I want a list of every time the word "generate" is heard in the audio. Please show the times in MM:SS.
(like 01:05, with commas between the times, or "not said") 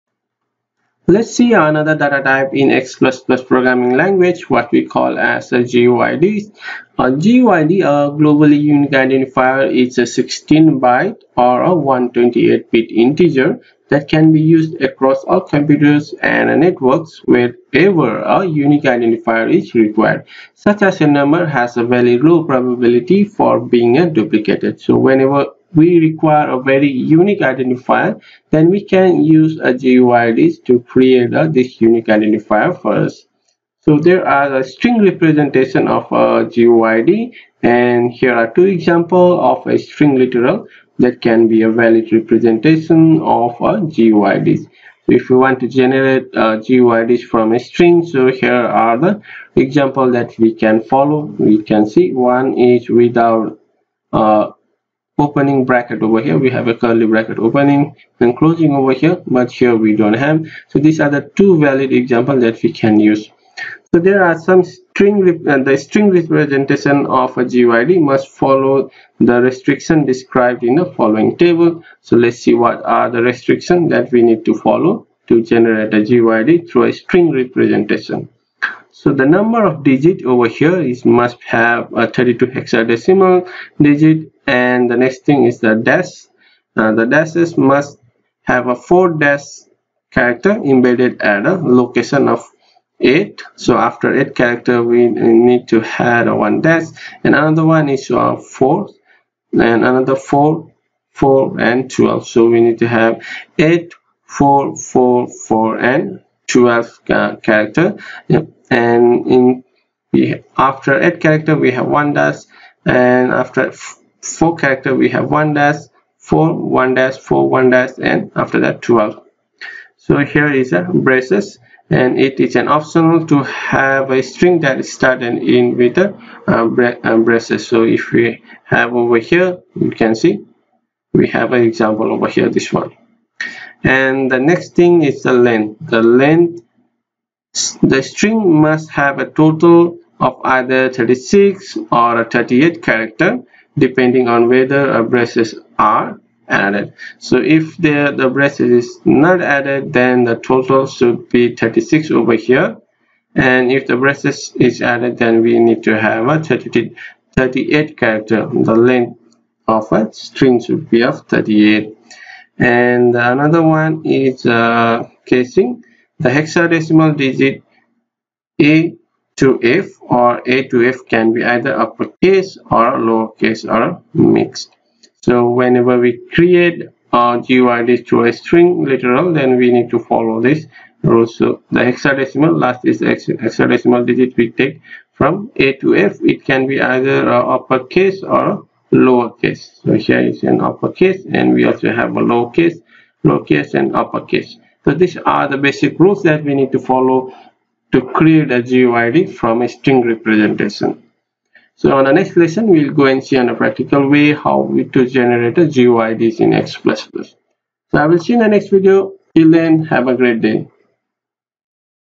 00:45, 01:15, 03:25.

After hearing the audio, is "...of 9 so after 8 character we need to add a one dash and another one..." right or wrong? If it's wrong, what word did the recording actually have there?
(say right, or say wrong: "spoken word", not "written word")
wrong: "8", not "9".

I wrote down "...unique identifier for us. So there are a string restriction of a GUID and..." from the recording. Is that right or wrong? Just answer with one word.
wrong.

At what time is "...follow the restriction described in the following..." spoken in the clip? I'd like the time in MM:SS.
01:08.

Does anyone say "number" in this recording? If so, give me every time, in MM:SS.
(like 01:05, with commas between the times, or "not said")
00:21, 01:19.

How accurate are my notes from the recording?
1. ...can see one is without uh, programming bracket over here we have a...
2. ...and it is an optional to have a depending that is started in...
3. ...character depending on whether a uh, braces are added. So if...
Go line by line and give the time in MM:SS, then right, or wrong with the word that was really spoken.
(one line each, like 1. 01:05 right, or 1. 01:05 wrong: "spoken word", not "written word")
1. 00:51 wrong: "opening", not "programming"
2. 02:01 wrong: "string", not "depending"
3. 02:22 right.